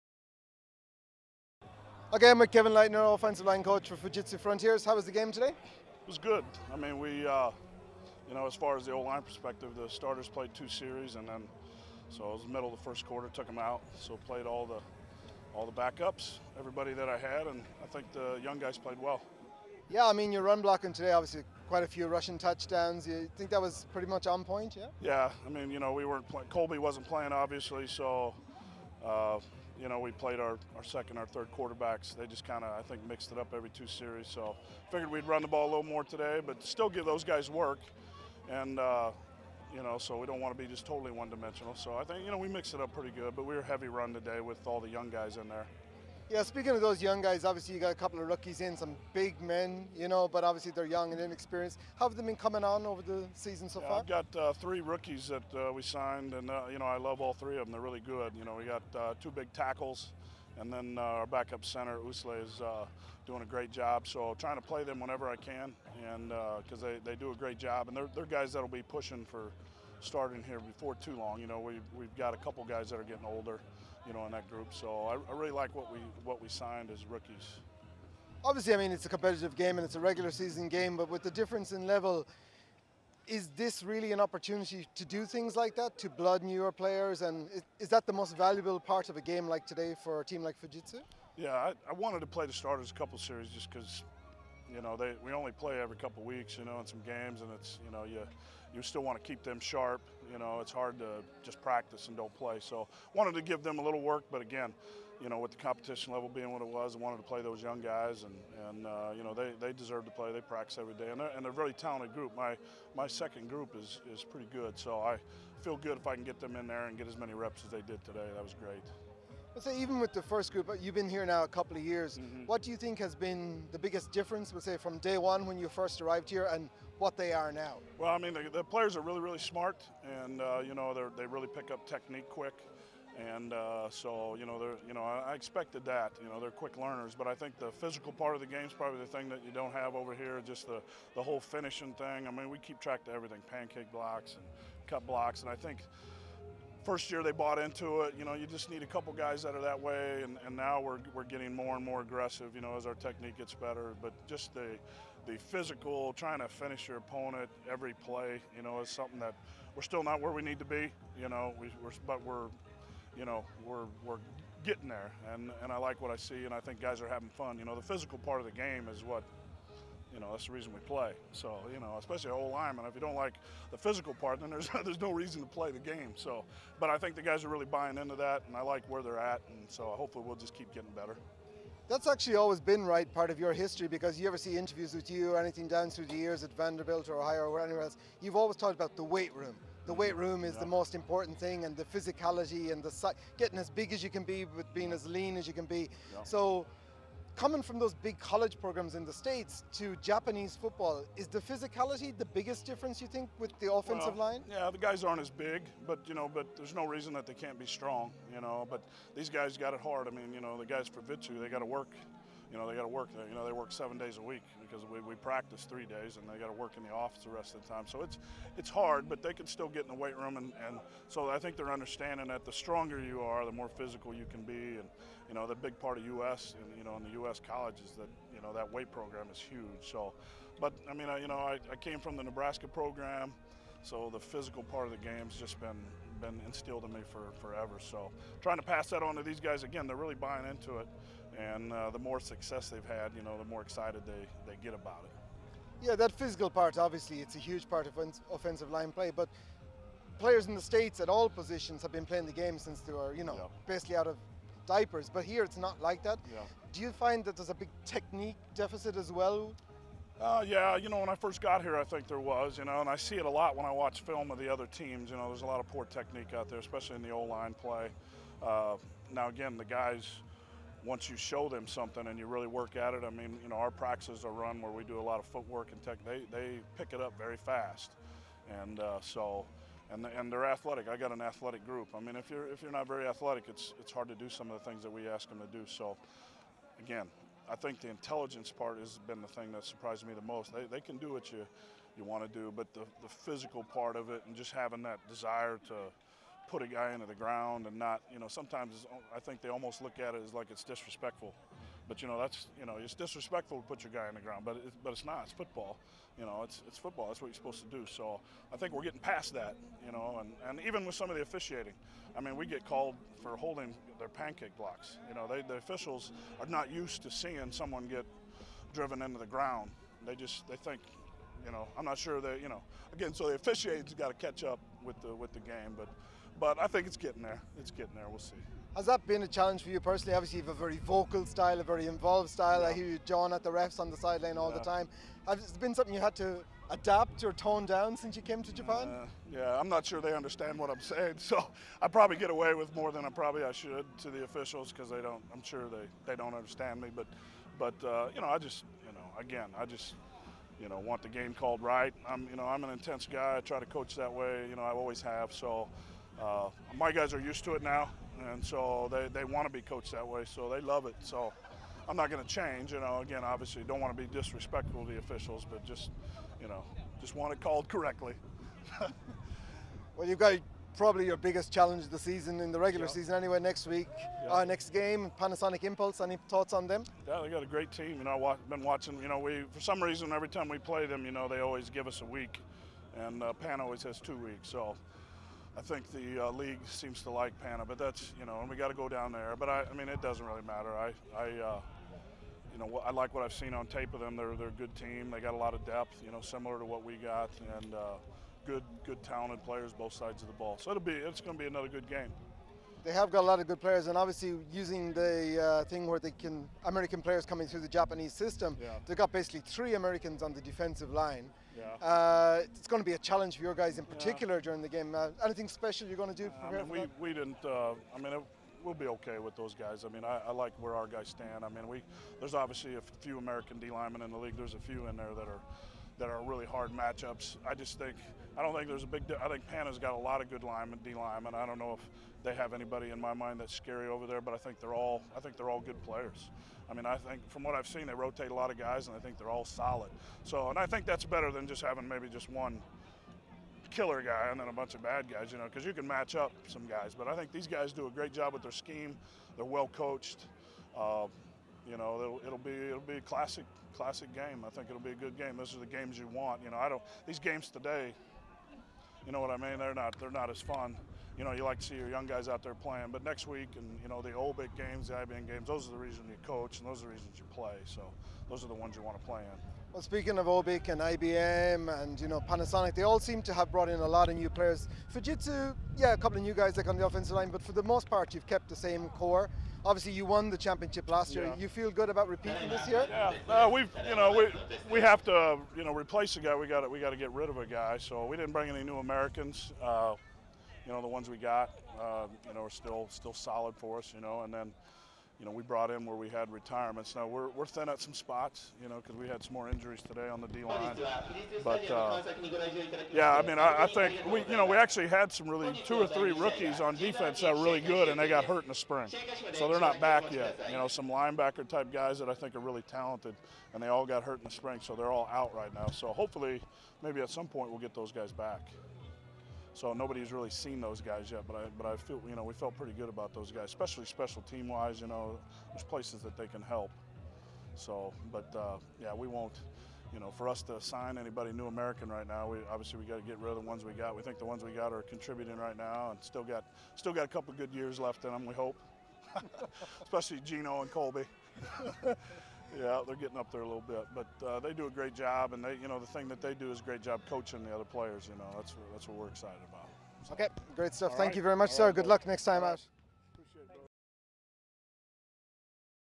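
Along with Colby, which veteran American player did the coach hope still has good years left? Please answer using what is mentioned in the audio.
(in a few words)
Gino.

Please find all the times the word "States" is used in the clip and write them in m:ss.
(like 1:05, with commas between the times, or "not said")
3:19, 4:10.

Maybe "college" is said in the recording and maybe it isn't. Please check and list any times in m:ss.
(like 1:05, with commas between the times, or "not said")
3:18, 3:47.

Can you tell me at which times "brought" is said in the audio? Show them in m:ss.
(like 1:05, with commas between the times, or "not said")
7:53, 8:15.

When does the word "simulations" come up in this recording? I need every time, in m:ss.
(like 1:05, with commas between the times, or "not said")
not said.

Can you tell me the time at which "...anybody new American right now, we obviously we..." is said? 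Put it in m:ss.
8:50.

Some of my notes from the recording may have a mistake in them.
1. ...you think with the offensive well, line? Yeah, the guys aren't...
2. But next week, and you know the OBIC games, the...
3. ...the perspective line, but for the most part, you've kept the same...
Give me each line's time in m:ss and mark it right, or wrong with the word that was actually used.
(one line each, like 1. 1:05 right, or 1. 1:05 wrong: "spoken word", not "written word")
1. 3:23 right
2. 7:42 right
3. 7:56 wrong: "offensive", not "perspective".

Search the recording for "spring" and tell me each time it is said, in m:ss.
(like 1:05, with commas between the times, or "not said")
8:28, 8:34.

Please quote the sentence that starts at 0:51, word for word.
How have they been coming on over the season so yeah, far?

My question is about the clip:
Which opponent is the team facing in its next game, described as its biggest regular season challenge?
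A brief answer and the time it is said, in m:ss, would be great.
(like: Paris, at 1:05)
Panasonic Impulse, at 6:15.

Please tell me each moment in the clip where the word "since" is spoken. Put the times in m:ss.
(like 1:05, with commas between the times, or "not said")
4:12, 5:37.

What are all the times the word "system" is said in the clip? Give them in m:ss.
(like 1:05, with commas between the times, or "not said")
6:48.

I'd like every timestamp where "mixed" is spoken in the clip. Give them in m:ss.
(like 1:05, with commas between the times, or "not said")
0:33, 0:42.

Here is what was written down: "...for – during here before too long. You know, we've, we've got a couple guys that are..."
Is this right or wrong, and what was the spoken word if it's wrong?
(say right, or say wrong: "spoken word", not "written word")
wrong: "starting", not "during".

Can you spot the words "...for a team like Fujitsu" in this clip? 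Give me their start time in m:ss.
1:30.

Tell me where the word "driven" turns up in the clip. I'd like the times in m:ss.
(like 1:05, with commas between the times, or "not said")
5:18.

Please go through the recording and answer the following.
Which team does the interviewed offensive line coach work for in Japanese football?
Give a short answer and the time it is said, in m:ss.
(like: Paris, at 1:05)
Fujitsu Frontiers, at 0:03.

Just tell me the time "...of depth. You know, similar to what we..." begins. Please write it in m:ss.
6:35.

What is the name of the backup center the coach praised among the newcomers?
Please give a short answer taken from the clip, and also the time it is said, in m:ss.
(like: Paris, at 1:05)
Usle, at 1:01.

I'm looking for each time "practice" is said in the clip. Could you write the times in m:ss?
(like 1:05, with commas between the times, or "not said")
1:41, 1:50, 3:35, 4:33.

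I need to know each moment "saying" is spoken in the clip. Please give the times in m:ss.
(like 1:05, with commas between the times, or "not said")
5:40.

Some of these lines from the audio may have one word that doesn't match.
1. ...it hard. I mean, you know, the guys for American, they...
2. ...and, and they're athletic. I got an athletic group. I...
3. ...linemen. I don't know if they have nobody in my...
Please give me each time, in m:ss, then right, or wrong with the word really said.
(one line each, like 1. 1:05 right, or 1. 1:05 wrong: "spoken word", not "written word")
1. 3:29 wrong: "Fujitsu", not "American"
2. 4:39 right
3. 7:10 wrong: "anybody", not "nobody".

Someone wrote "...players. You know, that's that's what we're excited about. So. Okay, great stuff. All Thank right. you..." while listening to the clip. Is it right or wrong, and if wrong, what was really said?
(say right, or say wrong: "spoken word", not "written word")
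right.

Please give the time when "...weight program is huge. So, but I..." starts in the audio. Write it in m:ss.
3:48.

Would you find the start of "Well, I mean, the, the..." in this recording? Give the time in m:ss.
2:07.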